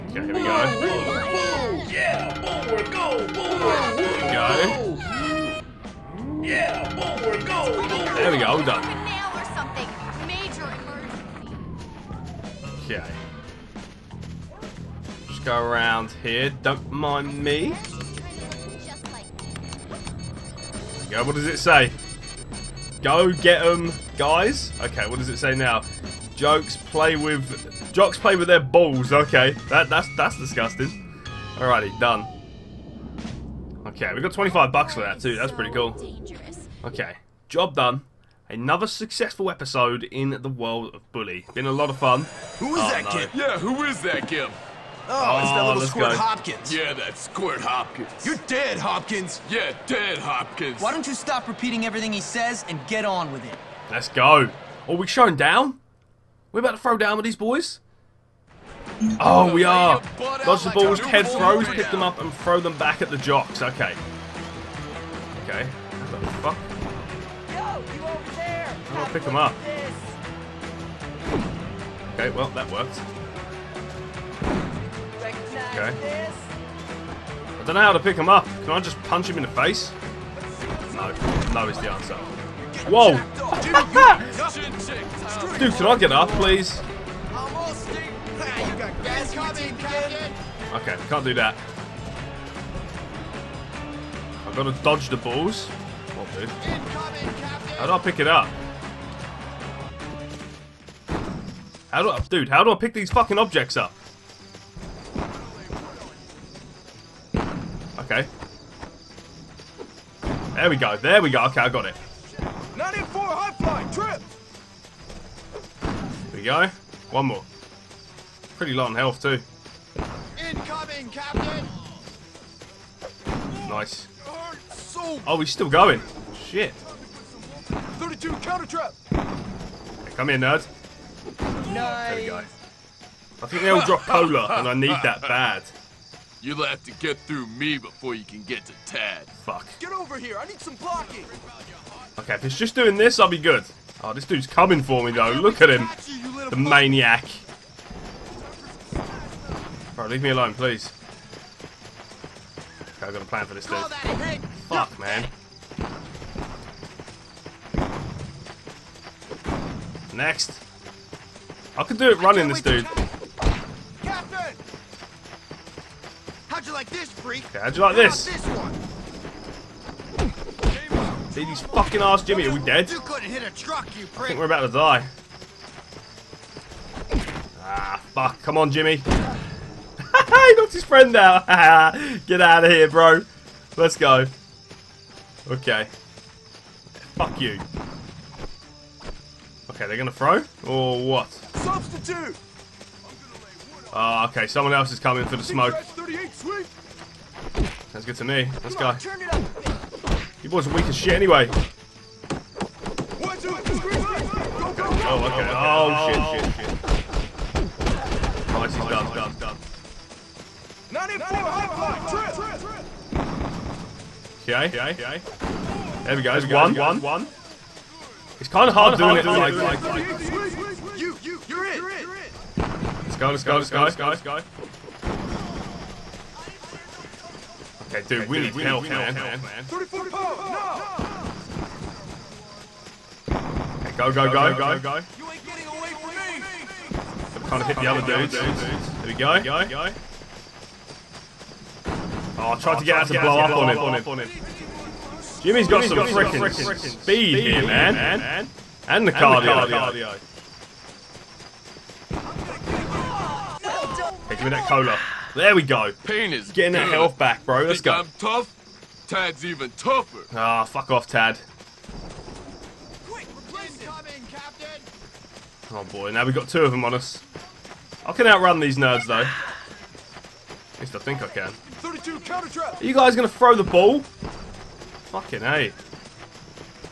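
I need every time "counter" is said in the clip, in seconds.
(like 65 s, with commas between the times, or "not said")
128 s, 272 s.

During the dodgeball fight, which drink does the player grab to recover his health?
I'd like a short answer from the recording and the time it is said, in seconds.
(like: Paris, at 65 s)
cola, at 254 s.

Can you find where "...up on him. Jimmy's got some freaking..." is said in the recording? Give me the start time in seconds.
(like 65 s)
243 s.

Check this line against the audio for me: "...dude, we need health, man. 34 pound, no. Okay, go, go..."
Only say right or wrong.
right.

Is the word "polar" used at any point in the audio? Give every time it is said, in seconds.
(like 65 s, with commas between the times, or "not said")
134 s.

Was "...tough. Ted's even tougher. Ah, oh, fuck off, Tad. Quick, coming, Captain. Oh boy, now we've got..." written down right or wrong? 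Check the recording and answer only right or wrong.
right.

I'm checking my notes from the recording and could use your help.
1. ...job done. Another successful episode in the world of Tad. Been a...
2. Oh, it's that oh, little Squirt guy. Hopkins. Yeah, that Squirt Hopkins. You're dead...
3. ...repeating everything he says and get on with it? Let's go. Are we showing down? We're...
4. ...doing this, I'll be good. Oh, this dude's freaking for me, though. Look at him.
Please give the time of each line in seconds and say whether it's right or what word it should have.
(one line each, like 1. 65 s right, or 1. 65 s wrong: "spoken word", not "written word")
1. 37 s wrong: "Bully", not "Tad"
2. 45 s right
3. 51 s right
4. 142 s wrong: "coming", not "freaking".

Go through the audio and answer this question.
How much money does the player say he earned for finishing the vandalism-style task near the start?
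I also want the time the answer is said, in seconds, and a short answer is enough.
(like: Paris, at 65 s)
$25, at 34 s.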